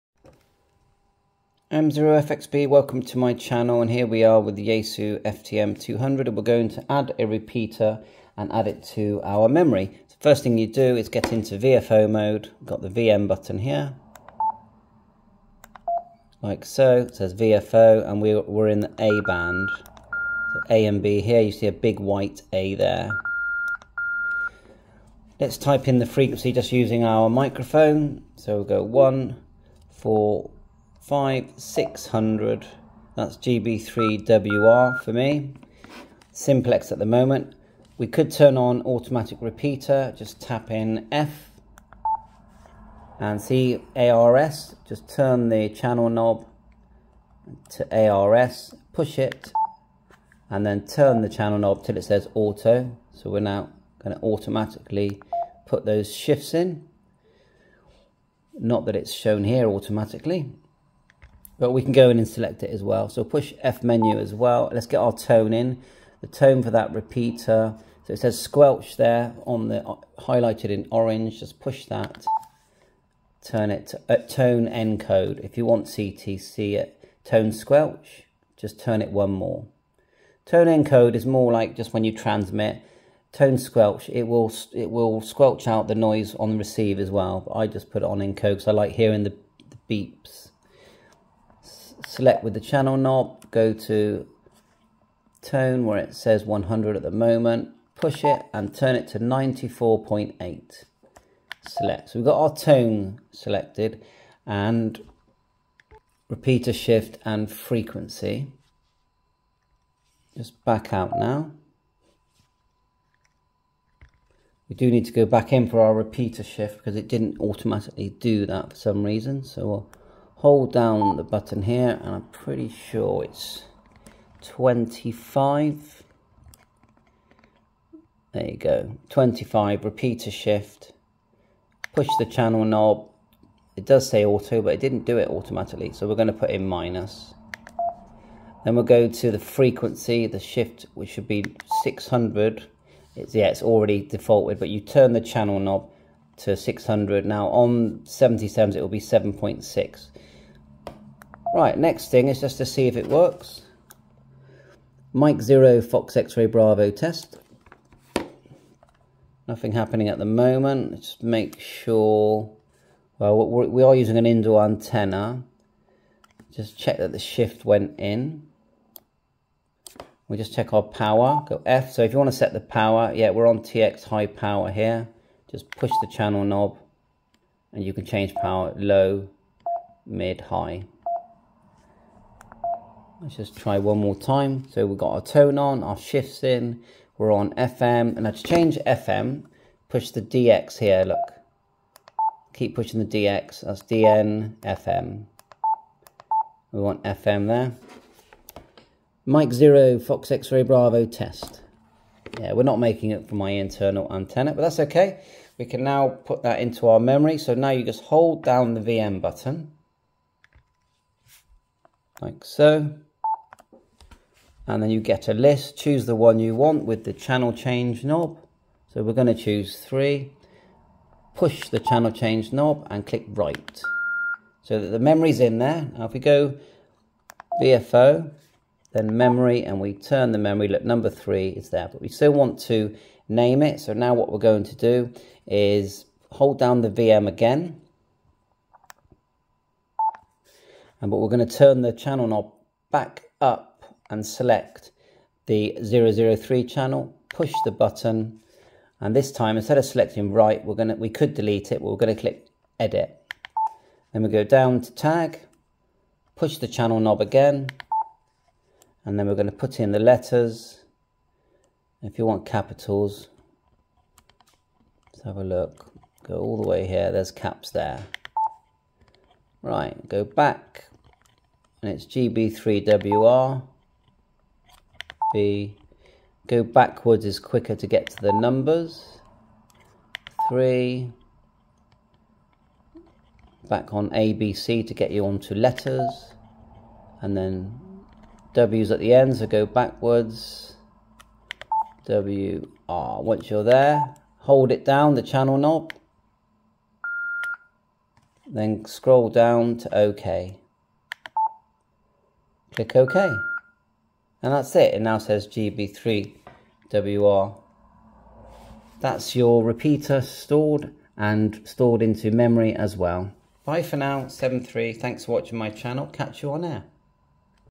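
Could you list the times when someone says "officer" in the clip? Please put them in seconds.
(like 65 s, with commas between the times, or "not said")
not said.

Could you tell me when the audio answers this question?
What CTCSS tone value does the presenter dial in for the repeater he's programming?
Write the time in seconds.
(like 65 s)
99 s.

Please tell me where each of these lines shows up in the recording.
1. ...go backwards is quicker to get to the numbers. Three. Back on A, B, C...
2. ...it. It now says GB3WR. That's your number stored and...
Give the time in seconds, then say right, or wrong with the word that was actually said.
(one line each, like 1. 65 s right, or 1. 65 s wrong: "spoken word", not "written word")
1. 276 s right
2. 304 s wrong: "repeater", not "number".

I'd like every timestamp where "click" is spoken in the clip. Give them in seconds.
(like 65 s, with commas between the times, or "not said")
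223 s, 252 s, 302 s.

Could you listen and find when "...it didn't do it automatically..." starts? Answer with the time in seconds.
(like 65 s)
134 s.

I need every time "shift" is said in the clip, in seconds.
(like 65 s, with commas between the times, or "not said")
56 s, 106 s, 116 s, 130 s, 140 s, 167 s, 185 s.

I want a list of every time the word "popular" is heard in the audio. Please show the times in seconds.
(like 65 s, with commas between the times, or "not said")
not said.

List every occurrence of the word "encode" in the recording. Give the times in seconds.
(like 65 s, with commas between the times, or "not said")
74 s, 80 s, 88 s.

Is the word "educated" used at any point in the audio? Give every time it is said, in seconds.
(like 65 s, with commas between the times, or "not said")
not said.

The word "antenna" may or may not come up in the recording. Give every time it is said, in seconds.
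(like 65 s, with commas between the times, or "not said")
164 s, 204 s.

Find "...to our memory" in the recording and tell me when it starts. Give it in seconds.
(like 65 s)
8 s.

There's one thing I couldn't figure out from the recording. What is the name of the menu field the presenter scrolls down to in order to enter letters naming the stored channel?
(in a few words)
tag.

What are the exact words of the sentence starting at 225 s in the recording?
Now if we go VFO, then memory, and we turn the memory, look, number three is there.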